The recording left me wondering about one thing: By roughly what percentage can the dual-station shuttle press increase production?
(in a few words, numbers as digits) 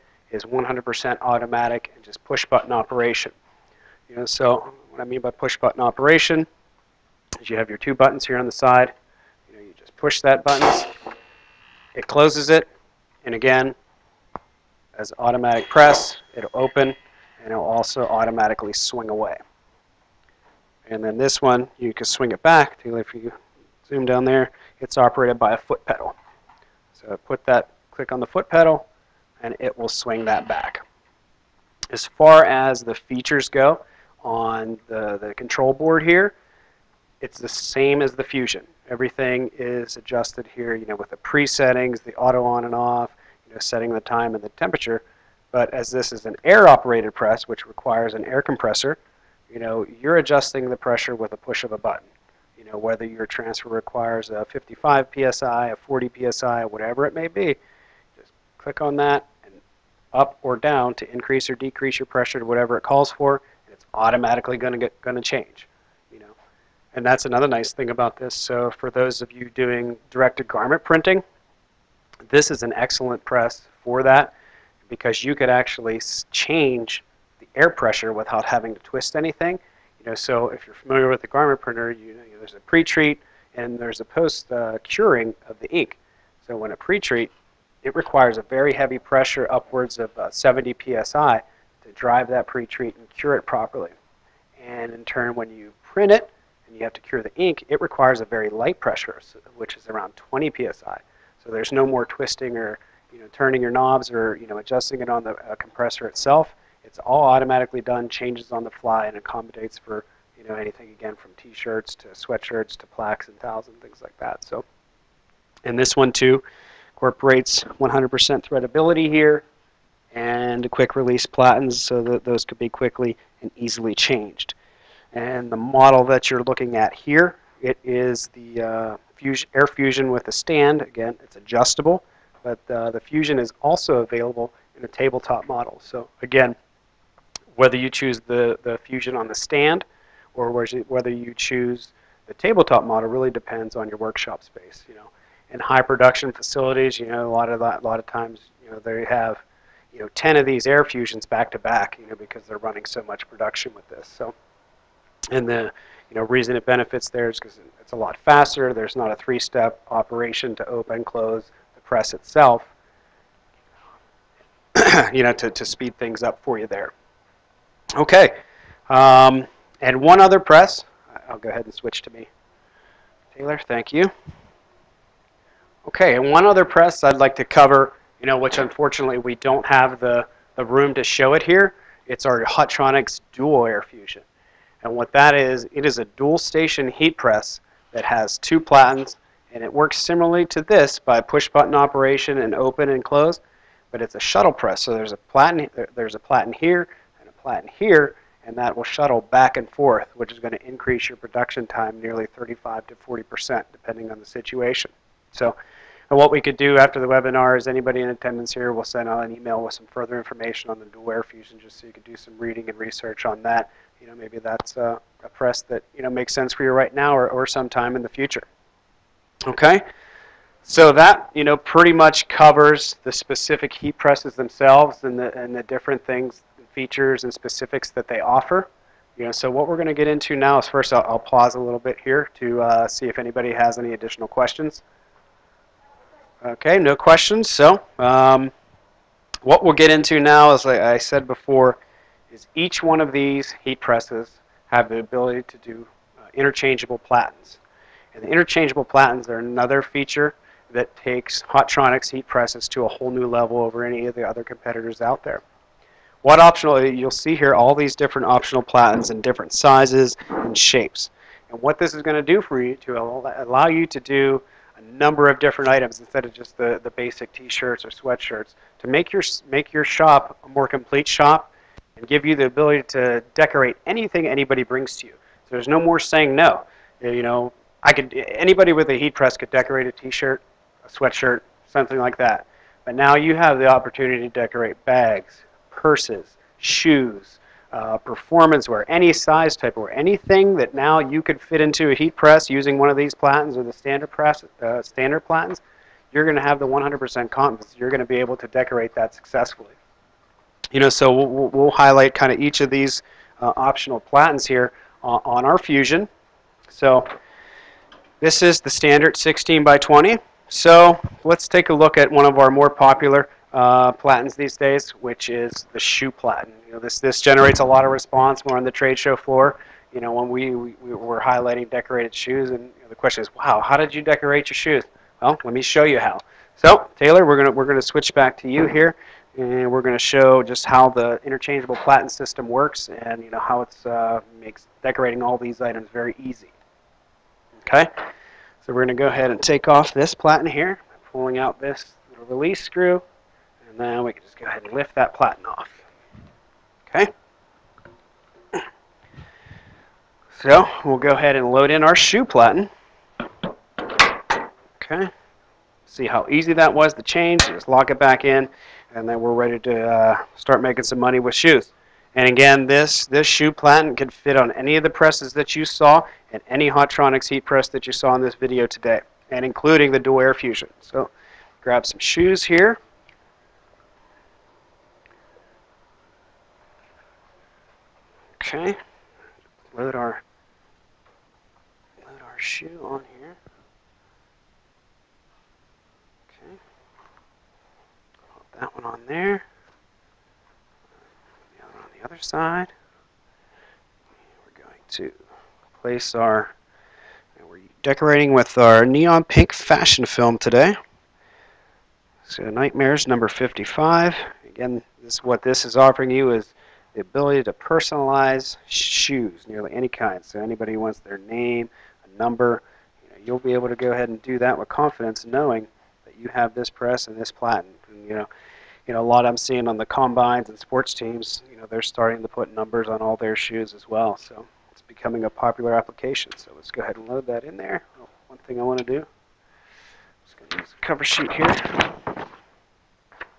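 35 to 40%.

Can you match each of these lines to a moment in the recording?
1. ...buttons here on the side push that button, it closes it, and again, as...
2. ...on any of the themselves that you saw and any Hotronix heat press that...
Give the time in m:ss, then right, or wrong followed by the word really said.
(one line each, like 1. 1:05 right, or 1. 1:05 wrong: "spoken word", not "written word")
1. 0:07 right
2. 6:04 wrong: "presses", not "themselves".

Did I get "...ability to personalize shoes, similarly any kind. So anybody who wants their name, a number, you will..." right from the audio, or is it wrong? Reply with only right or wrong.
wrong.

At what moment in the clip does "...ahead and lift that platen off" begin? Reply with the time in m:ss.
5:44.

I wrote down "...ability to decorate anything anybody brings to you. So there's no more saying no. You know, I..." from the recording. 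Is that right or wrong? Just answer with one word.
right.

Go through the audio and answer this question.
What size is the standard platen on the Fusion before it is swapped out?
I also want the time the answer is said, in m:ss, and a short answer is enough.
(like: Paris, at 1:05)
16 by 20, at 5:09.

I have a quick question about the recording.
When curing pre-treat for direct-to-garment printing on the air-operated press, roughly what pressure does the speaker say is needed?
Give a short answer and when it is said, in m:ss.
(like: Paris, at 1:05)
70 psi, at 1:30.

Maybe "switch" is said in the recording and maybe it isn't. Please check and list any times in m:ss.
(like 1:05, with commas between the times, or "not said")
2:51, 5:27.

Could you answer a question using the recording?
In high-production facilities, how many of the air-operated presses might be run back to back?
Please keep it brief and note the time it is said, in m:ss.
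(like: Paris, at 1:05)
10, at 2:30.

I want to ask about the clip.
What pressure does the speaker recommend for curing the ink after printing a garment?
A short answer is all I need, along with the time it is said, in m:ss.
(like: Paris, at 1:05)
20 psi, at 1:40.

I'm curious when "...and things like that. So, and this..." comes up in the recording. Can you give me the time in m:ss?
1:53.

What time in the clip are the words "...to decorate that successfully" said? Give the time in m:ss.
4:58.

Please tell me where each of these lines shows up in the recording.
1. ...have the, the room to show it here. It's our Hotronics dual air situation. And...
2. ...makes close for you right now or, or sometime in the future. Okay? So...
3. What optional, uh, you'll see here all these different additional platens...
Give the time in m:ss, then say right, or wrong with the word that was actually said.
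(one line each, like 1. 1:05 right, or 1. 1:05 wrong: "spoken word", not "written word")
1. 2:59 wrong: "fusion", not "situation"
2. 3:36 wrong: "sense", not "close"
3. 4:16 wrong: "optional", not "additional".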